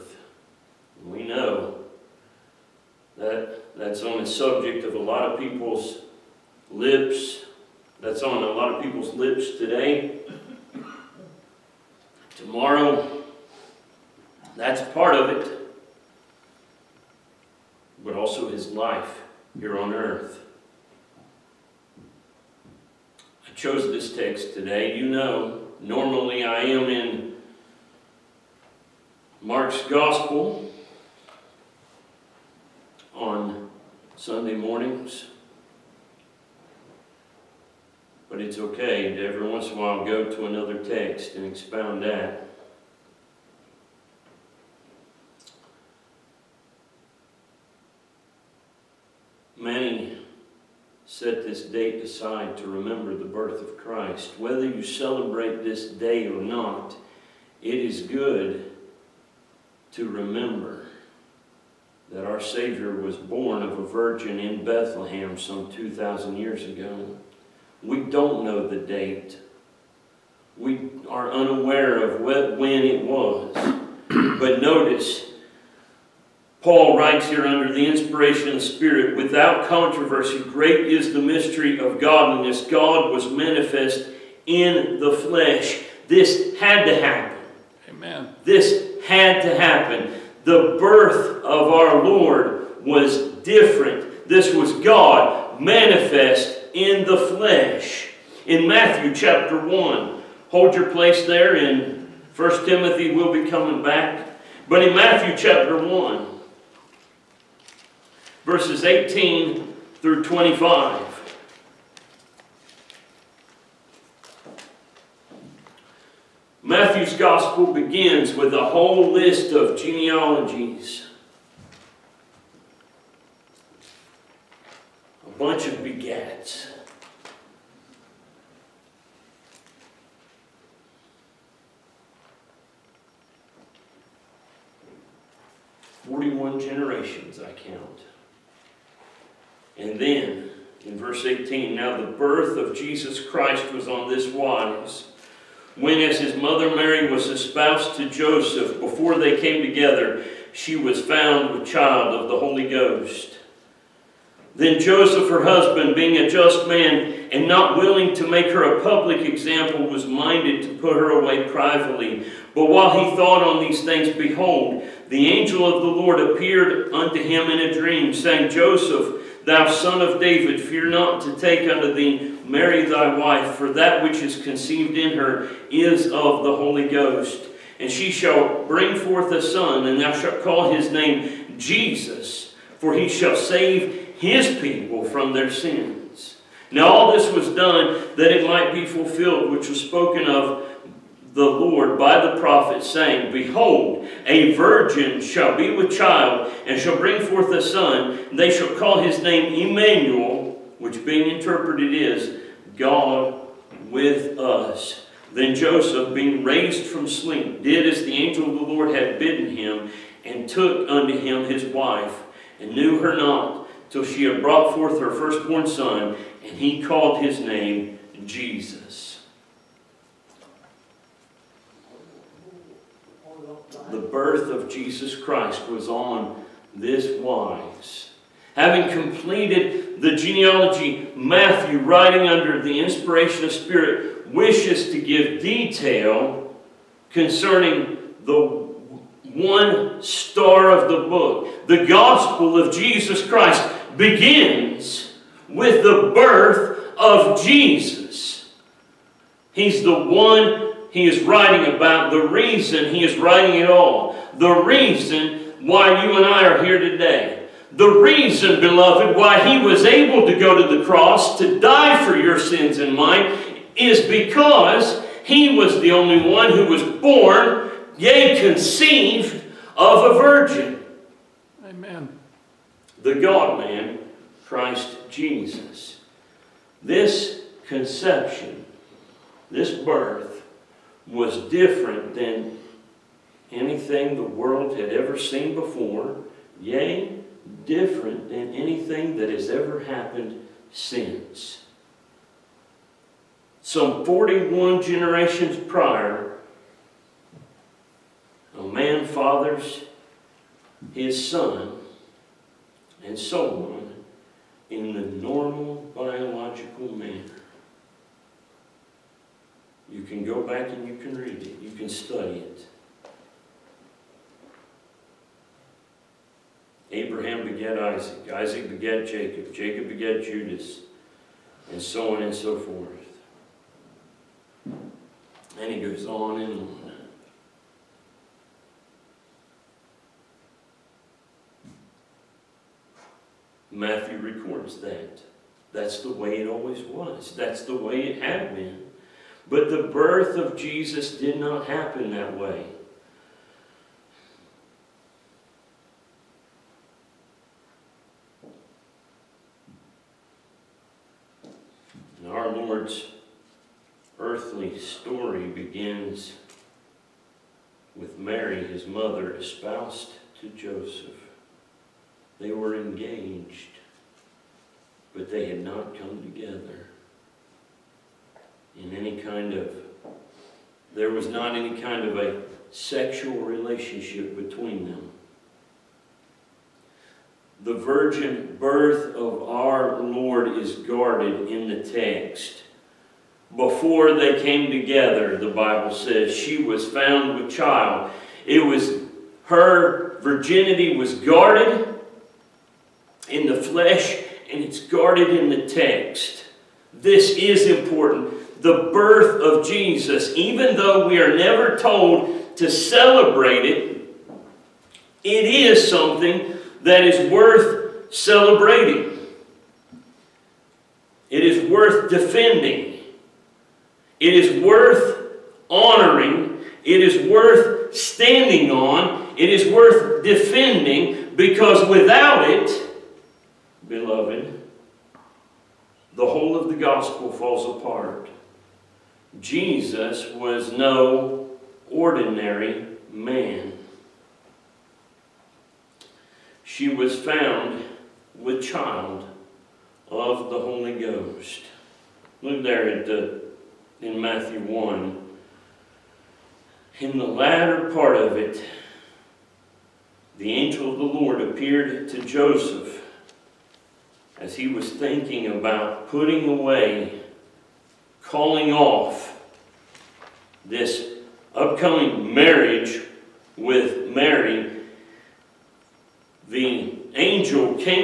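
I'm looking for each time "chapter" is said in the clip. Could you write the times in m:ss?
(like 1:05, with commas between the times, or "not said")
1:39, 1:45.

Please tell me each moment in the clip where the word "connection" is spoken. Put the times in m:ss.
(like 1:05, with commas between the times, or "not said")
not said.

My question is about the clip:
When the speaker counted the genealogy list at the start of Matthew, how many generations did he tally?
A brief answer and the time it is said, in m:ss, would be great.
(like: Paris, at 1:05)
41, at 2:16.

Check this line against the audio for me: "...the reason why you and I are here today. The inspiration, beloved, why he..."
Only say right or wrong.
wrong.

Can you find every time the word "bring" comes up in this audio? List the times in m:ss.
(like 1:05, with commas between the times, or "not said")
2:58, 3:16.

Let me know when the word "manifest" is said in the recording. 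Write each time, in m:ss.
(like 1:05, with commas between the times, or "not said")
1:23, 1:35.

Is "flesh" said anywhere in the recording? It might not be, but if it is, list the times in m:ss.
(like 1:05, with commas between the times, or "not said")
1:25, 1:37, 6:33.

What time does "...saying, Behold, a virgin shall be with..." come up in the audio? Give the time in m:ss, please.
3:12.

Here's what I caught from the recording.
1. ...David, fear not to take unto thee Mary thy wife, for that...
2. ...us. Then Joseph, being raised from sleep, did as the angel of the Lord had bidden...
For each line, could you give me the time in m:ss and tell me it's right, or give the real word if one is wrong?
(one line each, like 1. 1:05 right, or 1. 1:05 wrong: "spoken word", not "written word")
1. 2:50 right
2. 3:24 right.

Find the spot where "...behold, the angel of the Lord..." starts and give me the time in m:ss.
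2:44.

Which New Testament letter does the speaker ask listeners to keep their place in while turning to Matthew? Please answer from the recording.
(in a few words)
1 Timothy.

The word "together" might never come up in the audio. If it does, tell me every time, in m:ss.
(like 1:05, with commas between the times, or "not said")
2:29, 6:06, 6:24.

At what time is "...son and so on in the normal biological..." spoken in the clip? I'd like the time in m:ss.
5:01.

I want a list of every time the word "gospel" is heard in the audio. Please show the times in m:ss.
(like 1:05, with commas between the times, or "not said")
0:29, 1:57, 4:01, 7:06.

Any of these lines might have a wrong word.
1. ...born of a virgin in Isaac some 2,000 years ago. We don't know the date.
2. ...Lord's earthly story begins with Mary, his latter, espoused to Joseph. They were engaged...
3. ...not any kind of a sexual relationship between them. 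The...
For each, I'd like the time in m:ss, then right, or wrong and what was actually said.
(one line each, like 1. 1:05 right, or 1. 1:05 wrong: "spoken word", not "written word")
1. 1:03 wrong: "Bethlehem", not "Isaac"
2. 5:52 wrong: "mother", not "latter"
3. 6:11 right.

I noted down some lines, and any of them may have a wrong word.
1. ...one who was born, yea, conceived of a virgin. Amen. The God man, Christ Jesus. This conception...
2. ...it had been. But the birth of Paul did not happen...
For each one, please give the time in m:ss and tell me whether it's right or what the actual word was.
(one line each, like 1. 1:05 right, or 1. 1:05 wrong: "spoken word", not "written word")
1. 4:26 right
2. 5:38 wrong: "Jesus", not "Paul".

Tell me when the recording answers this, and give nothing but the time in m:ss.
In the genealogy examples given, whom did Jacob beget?
5:20.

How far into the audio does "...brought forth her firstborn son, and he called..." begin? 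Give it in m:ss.
3:34.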